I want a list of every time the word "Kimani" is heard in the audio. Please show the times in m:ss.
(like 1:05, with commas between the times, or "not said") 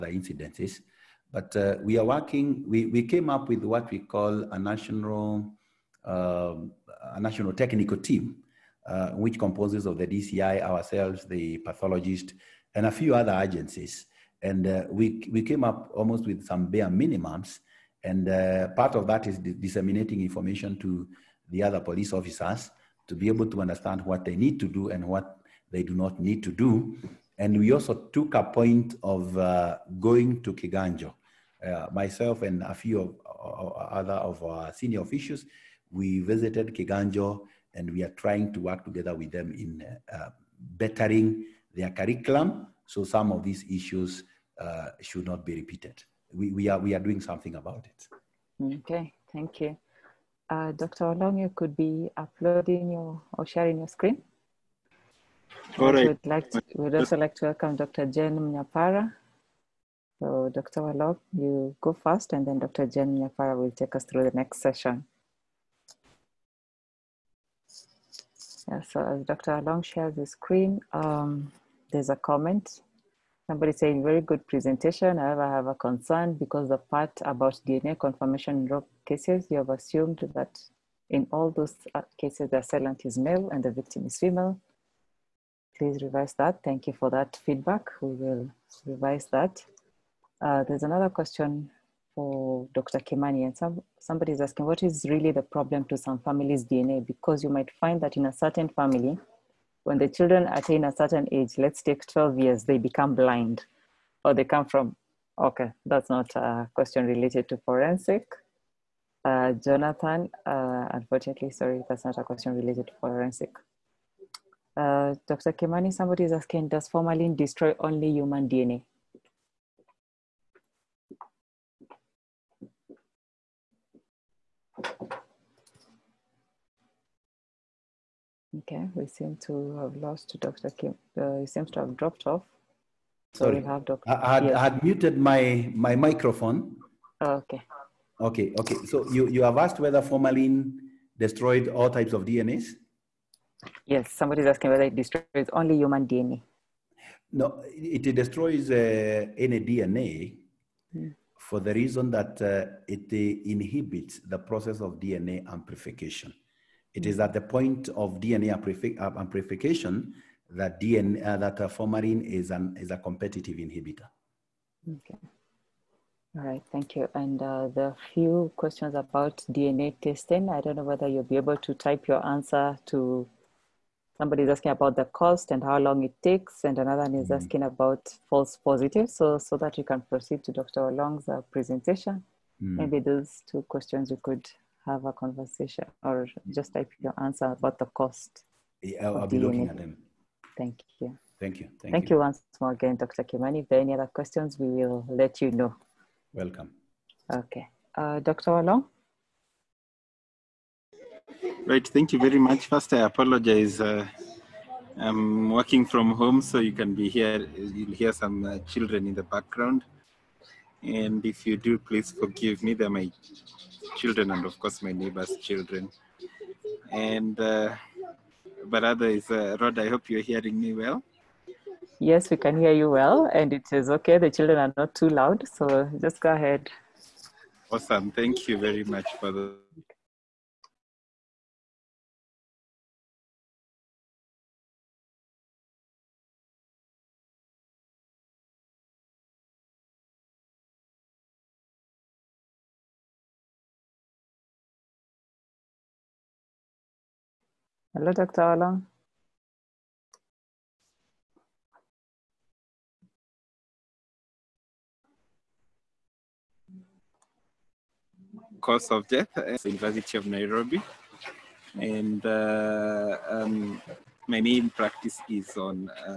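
1:32, 1:55, 3:13.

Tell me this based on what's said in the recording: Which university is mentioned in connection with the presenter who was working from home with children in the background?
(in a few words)
University of Nairobi.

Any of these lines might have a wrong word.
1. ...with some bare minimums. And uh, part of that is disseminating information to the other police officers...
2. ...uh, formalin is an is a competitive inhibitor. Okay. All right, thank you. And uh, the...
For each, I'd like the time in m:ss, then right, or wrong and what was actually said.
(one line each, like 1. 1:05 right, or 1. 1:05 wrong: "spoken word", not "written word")
1. 0:16 right
2. 2:41 right.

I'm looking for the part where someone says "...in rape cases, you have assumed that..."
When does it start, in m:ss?
1:18.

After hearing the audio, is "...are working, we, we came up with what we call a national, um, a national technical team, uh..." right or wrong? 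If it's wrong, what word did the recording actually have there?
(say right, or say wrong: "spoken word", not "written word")
right.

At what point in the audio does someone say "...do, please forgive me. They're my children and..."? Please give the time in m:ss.
3:31.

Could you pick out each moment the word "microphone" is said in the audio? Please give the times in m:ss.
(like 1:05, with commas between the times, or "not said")
2:15.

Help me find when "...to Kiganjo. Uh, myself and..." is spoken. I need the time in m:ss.
0:30.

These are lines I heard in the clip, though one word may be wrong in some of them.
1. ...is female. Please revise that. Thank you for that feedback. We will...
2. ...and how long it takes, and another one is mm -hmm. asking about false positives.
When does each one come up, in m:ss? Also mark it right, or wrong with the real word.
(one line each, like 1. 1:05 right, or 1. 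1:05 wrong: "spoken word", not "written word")
1. 1:24 right
2. 2:55 right.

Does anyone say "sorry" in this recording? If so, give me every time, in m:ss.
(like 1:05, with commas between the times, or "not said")
1:51, 2:13.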